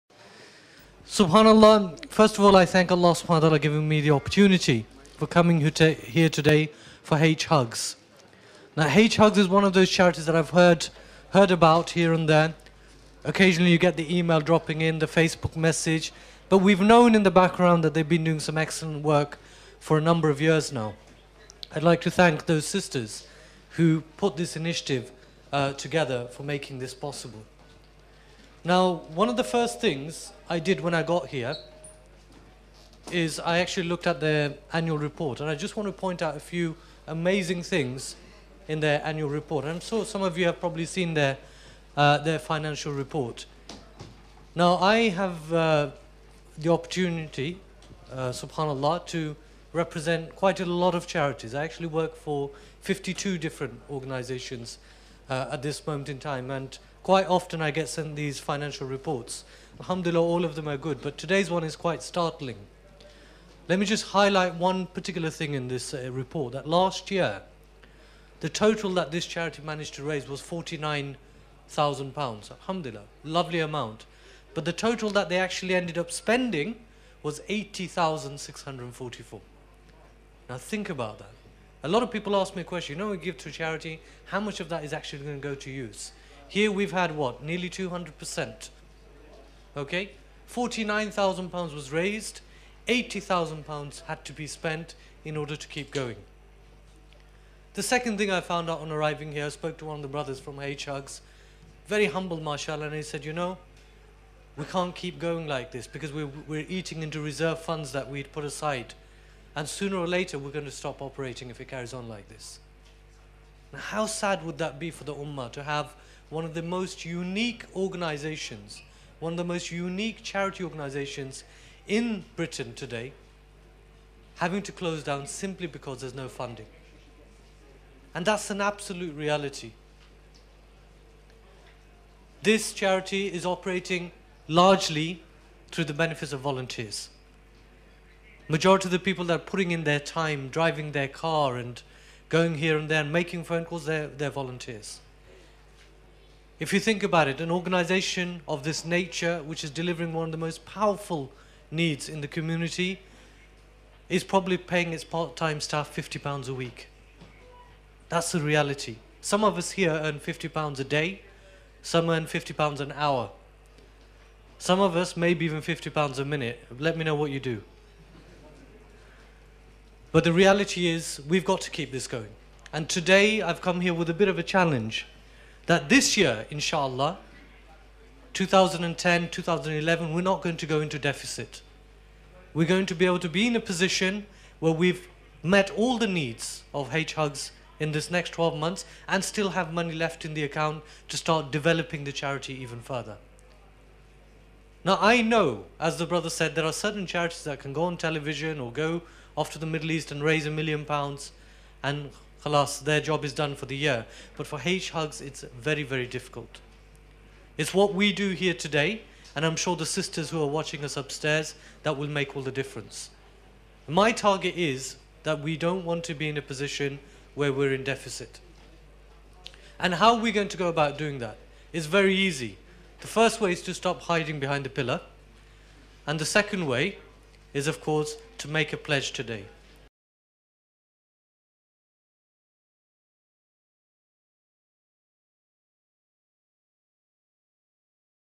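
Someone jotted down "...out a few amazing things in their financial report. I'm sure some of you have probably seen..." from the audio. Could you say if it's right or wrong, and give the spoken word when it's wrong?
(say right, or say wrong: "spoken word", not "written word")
wrong: "annual", not "financial".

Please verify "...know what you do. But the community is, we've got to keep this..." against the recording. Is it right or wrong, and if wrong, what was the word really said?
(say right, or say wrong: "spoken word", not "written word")
wrong: "reality", not "community".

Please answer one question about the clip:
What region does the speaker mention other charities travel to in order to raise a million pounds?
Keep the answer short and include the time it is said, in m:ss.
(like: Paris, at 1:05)
Middle East, at 3:19.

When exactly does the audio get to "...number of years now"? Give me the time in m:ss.
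0:20.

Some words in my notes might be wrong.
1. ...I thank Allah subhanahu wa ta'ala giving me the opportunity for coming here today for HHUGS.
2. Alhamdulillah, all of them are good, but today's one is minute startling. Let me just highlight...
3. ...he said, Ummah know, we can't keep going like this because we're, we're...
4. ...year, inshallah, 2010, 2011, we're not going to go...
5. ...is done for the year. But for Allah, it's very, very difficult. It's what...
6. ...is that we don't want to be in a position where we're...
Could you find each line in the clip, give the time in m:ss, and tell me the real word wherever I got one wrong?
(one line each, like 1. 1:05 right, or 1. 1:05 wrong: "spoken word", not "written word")
1. 0:02 right
2. 0:59 wrong: "quite", not "minute"
3. 1:42 wrong: "You", not "Ummah"
4. 2:56 right
5. 3:23 wrong: "HHUGS", not "Allah"
6. 3:34 right.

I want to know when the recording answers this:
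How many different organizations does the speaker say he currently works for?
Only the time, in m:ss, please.
0:52.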